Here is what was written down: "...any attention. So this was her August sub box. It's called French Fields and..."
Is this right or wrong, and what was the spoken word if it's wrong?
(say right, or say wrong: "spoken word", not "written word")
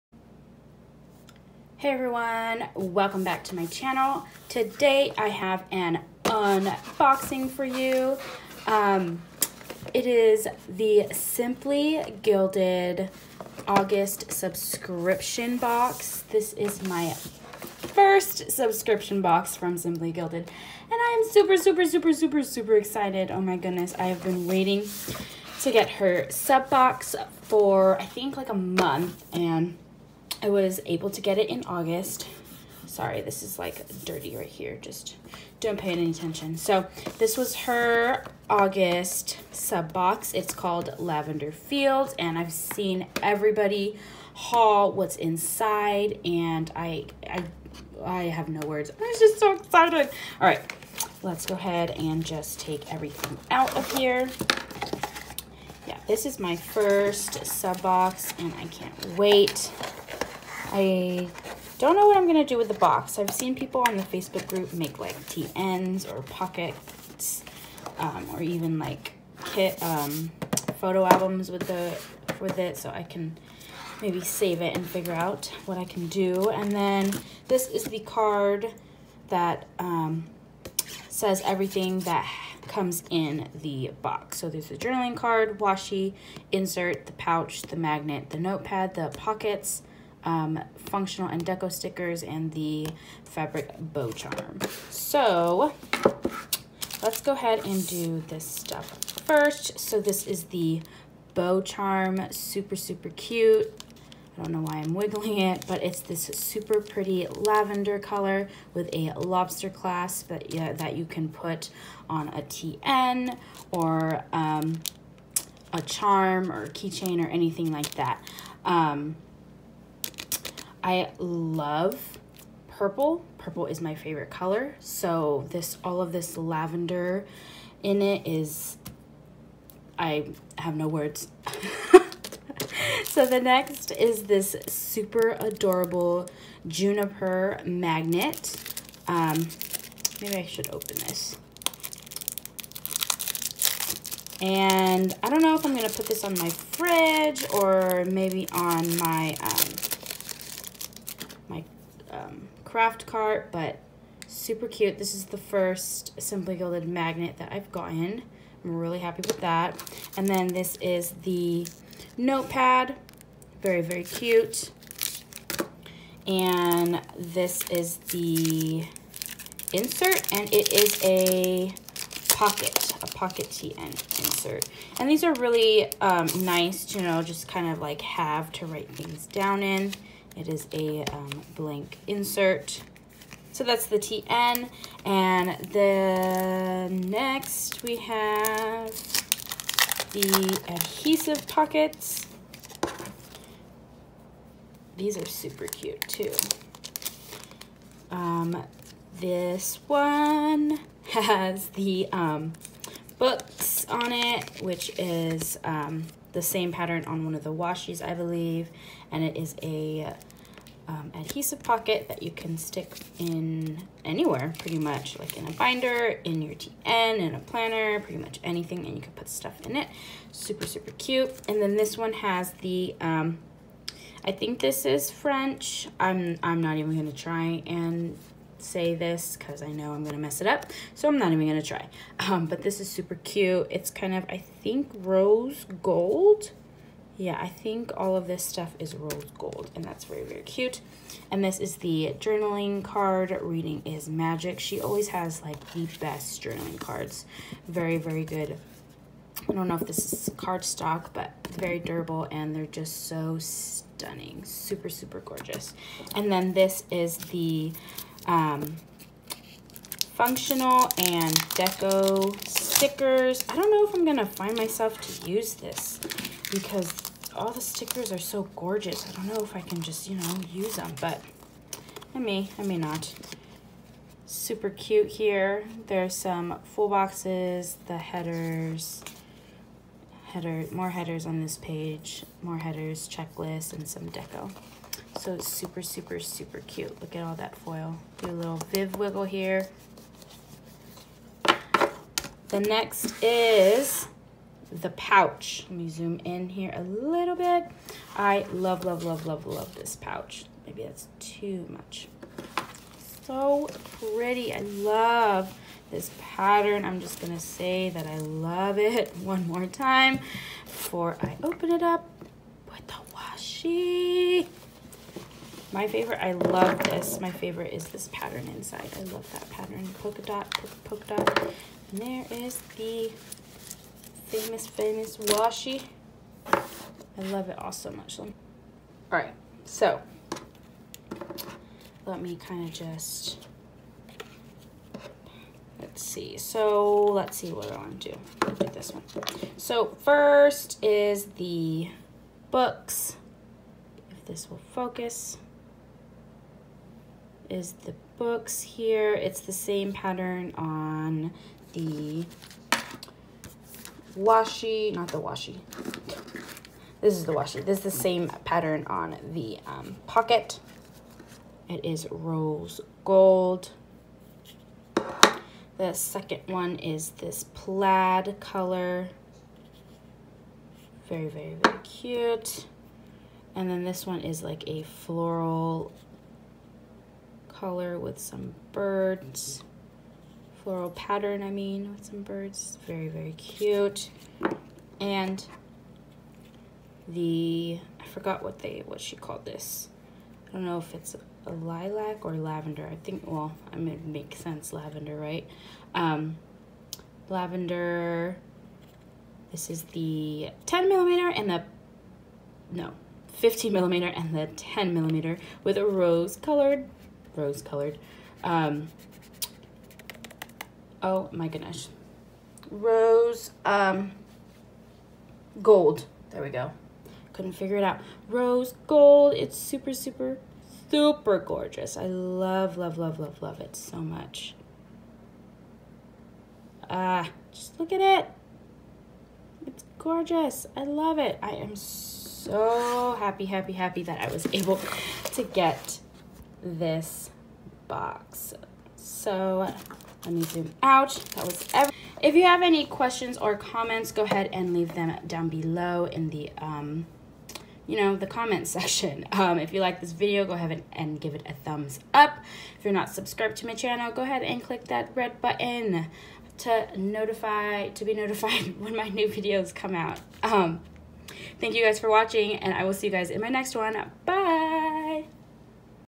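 wrong: "Lavender", not "French".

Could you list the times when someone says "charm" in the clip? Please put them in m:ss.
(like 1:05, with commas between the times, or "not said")
1:34, 1:41, 1:55.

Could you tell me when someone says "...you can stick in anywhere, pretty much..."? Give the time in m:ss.
3:32.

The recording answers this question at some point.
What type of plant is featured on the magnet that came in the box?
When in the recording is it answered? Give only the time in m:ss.
2:16.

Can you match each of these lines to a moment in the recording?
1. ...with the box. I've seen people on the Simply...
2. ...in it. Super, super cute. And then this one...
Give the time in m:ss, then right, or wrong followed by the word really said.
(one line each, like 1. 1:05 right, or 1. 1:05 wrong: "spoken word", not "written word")
1. 1:02 wrong: "Facebook", not "Simply"
2. 3:39 right.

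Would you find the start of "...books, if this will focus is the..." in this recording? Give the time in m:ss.
5:42.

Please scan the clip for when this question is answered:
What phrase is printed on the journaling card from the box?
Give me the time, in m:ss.
4:03.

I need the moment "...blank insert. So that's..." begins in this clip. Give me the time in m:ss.
3:01.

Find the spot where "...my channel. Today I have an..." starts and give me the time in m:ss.
0:03.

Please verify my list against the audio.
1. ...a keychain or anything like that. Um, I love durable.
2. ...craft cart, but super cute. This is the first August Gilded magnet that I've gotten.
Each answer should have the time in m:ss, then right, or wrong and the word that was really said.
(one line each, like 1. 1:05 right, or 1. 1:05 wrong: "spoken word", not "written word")
1. 1:56 wrong: "purple", not "durable"
2. 2:32 wrong: "Simply", not "August".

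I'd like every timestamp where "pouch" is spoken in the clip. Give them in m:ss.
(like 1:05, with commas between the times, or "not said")
1:27, 4:54, 4:59.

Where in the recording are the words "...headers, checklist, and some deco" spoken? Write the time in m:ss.
4:42.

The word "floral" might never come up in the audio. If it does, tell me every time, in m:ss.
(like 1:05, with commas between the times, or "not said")
6:14, 6:20.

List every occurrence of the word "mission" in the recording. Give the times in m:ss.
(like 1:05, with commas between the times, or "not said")
not said.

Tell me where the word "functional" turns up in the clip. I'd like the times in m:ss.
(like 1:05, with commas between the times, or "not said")
1:30, 4:20.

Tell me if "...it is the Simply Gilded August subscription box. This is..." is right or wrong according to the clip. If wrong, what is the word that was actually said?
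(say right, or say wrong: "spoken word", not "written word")
right.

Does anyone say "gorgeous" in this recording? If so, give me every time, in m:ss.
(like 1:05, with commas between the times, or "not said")
4:15, 4:28, 7:01, 7:09.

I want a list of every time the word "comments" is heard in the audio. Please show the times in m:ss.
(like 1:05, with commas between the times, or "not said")
7:23, 7:28.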